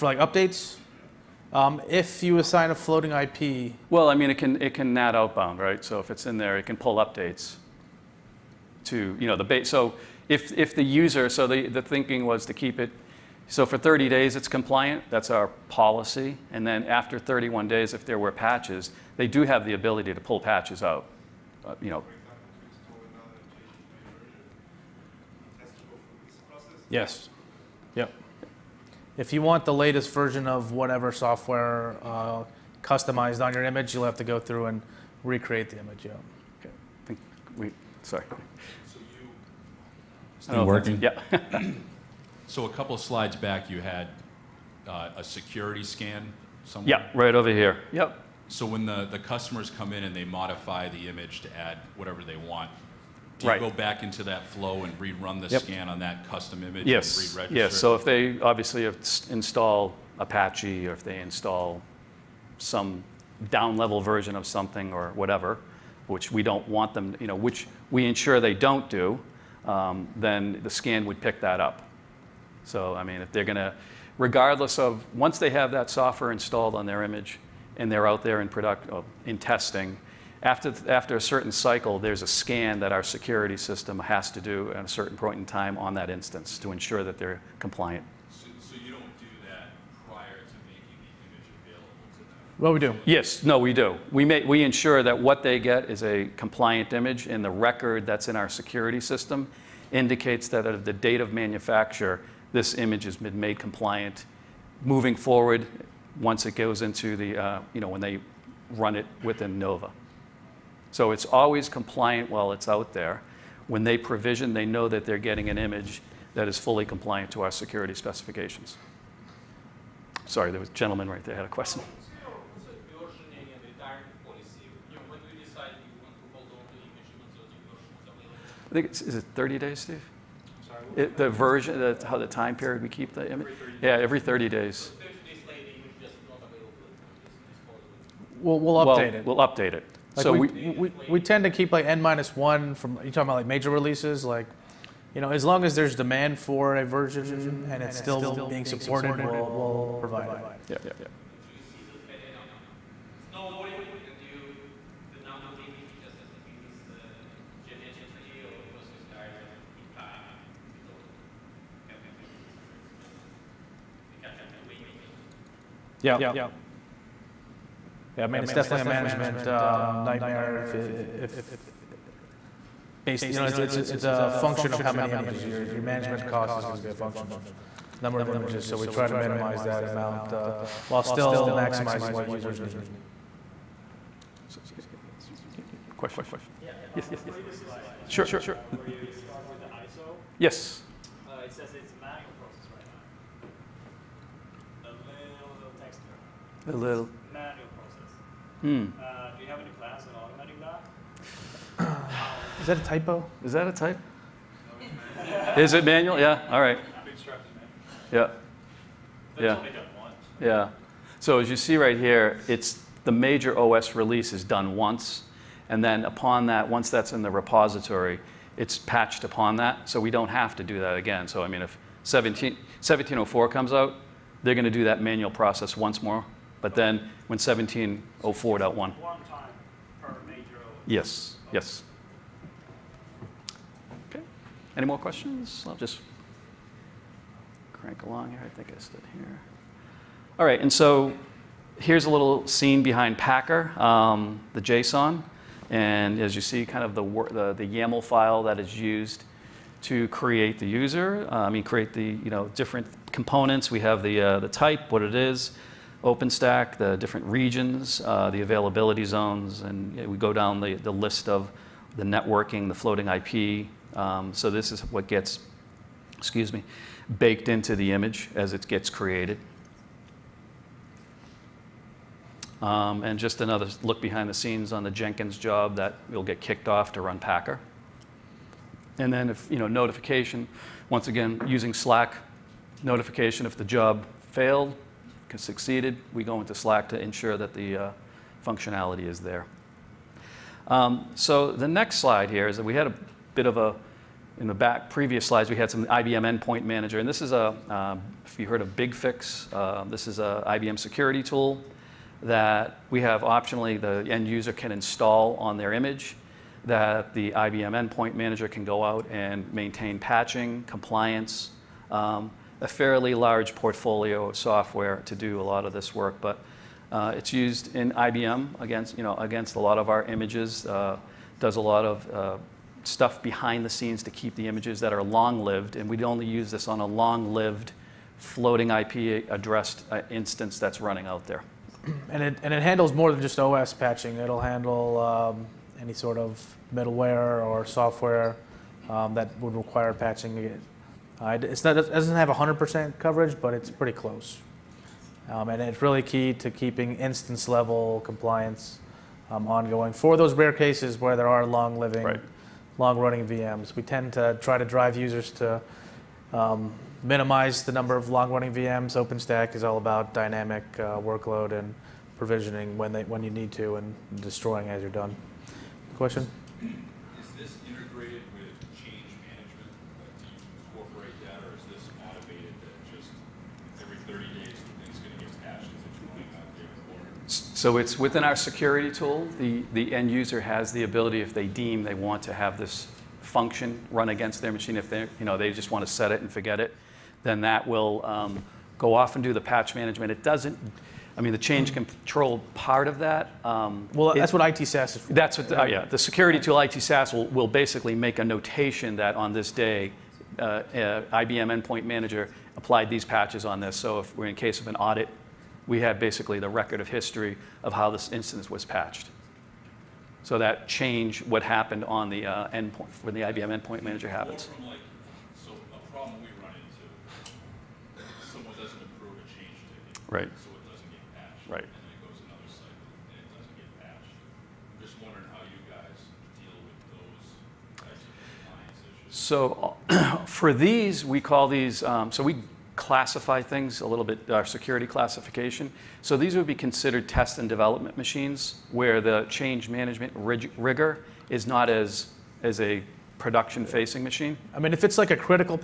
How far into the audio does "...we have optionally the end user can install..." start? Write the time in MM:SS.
05:02.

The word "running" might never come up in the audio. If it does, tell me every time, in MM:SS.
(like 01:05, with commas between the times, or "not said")
05:30, 05:52, 05:58.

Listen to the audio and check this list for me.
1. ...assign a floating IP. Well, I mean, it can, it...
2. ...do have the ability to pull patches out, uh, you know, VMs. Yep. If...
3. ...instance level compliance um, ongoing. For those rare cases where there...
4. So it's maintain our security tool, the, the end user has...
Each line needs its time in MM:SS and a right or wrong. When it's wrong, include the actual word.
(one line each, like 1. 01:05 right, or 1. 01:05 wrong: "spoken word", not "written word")
1. 00:02 right
2. 00:19 wrong: "Yes", not "VMs"
3. 05:46 right
4. 06:17 wrong: "within", not "maintain".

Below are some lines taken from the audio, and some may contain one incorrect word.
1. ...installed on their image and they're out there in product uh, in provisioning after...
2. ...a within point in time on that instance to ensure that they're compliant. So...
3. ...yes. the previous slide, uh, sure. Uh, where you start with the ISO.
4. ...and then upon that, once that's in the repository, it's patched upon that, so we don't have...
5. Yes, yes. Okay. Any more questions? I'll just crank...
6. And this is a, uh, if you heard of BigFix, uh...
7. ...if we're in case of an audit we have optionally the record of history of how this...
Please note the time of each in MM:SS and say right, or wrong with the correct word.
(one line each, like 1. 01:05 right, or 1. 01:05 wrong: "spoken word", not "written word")
1. 01:16 wrong: "testing", not "provisioning"
2. 01:24 wrong: "certain", not "within"
3. 03:06 right
4. 03:35 right
5. 03:50 right
6. 04:56 right
7. 06:43 wrong: "basically", not "optionally".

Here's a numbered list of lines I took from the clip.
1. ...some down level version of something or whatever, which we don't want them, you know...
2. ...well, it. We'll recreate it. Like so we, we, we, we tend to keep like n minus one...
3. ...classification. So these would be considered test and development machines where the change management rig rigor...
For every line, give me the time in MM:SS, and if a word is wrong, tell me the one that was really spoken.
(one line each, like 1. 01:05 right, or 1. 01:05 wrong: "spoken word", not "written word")
1. 01:02 right
2. 02:18 wrong: "update", not "recreate"
3. 07:14 right.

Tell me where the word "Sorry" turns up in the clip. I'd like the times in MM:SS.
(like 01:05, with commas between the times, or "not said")
00:38, 02:00, 02:10.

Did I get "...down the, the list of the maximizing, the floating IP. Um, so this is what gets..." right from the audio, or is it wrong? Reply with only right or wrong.
wrong.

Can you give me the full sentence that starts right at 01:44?
Moving forward, once it goes into the, uh, you know, when they run it within NOVA.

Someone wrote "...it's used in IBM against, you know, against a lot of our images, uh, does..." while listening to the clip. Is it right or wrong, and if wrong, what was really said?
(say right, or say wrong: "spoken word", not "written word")
right.